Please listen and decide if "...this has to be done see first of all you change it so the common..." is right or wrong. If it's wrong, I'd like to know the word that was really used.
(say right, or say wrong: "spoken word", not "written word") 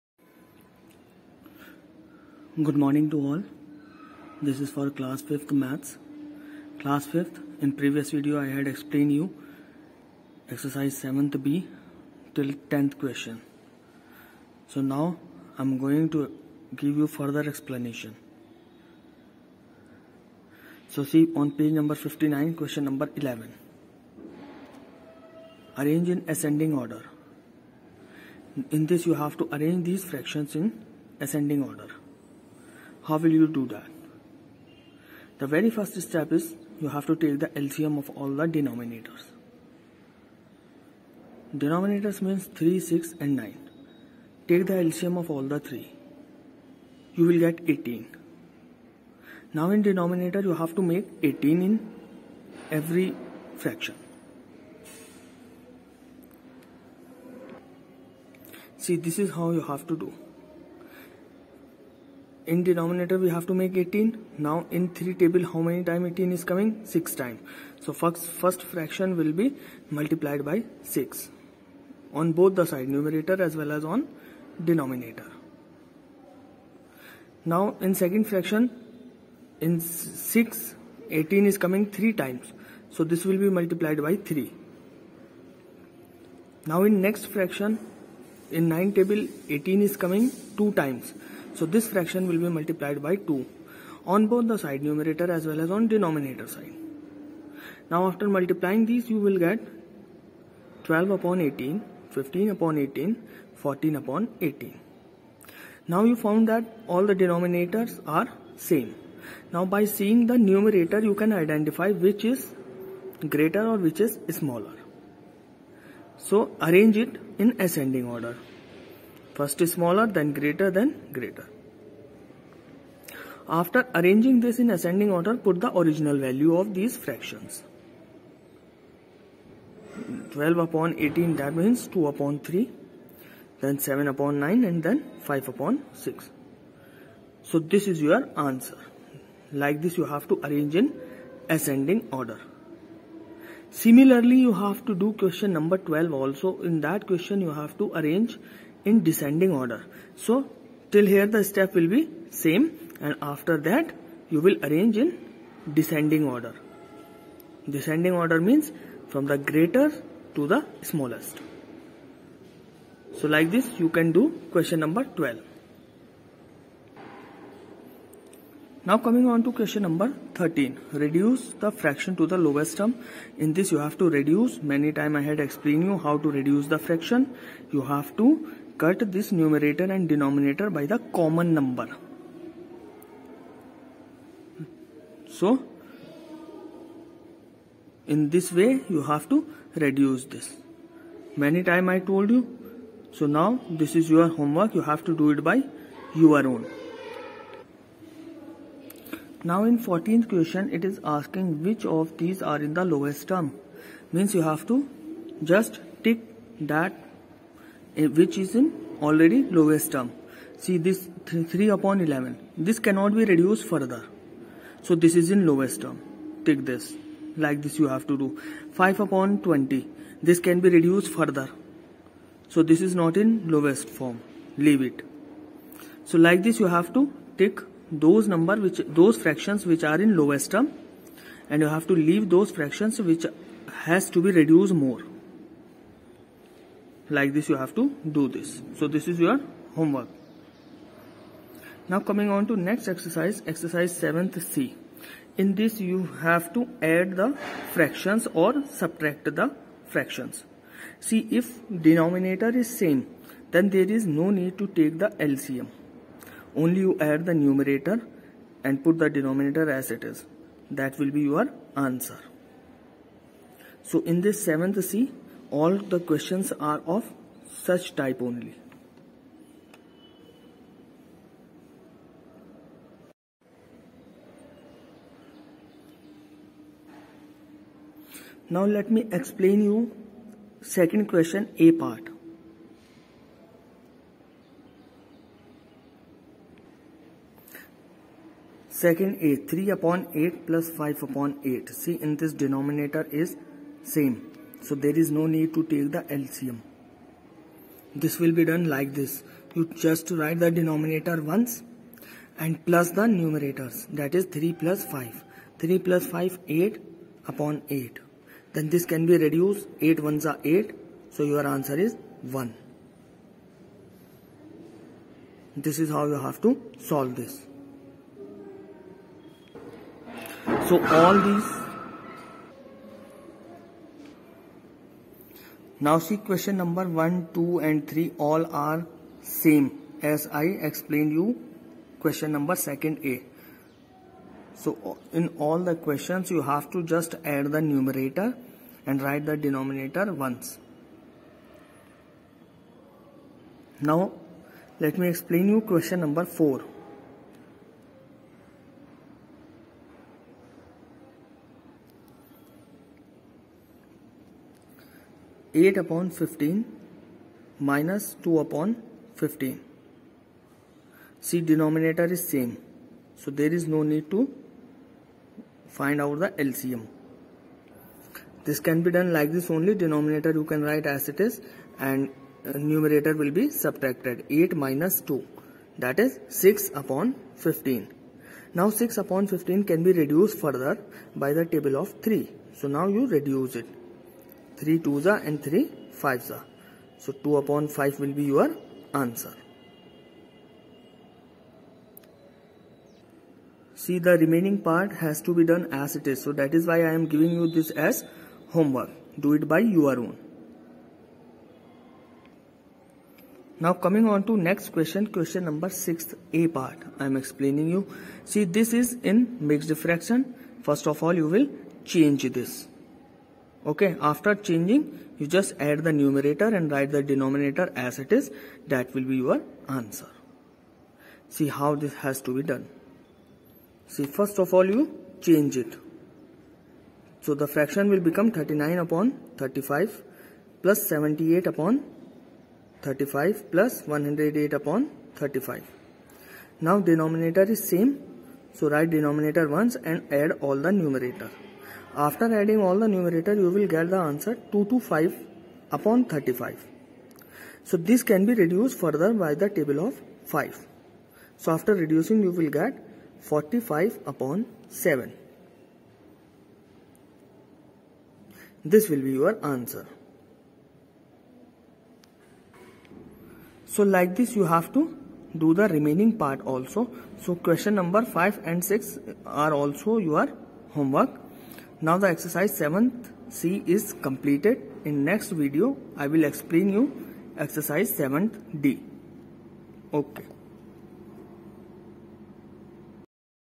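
wrong: "fraction", not "common".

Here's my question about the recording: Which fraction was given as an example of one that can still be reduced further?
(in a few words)
5/20.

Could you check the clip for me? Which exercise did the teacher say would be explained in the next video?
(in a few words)
Exercise 7D.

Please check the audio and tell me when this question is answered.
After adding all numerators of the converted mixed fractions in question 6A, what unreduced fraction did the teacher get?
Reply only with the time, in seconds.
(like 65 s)
444 s.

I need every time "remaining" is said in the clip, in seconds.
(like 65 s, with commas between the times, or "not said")
394 s, 465 s.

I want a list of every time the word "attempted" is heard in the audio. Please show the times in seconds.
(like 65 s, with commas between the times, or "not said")
not said.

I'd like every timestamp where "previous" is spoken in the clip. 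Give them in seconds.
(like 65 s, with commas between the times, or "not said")
7 s.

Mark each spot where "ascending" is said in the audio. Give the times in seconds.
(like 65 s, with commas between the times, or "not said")
26 s, 31 s, 117 s, 124 s, 141 s.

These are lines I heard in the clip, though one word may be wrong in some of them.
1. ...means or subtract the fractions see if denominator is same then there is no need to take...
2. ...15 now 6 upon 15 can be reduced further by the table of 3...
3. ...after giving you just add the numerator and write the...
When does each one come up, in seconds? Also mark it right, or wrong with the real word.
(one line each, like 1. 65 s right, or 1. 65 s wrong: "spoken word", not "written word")
1. 247 s wrong: "fractions", not "means"
2. 377 s right
3. 414 s wrong: "changing", not "giving".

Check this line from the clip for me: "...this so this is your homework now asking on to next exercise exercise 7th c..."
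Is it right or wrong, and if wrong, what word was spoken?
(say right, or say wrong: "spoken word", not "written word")
wrong: "coming", not "asking".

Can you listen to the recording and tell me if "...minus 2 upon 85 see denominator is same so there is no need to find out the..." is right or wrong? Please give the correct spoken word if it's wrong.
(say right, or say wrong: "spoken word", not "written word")
wrong: "15", not "85".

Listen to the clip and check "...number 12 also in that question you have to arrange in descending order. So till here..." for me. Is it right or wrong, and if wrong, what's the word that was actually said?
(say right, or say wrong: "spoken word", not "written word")
right.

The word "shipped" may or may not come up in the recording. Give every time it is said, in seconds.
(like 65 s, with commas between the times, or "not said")
not said.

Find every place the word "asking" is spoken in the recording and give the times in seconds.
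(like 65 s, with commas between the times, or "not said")
201 s.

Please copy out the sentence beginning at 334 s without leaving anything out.
So in all the questions you have to just add the numerator and write the denominator once.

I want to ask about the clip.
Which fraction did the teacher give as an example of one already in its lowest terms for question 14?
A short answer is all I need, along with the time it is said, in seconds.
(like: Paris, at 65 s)
3/11, at 211 s.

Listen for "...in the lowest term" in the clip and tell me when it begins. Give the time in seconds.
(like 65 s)
202 s.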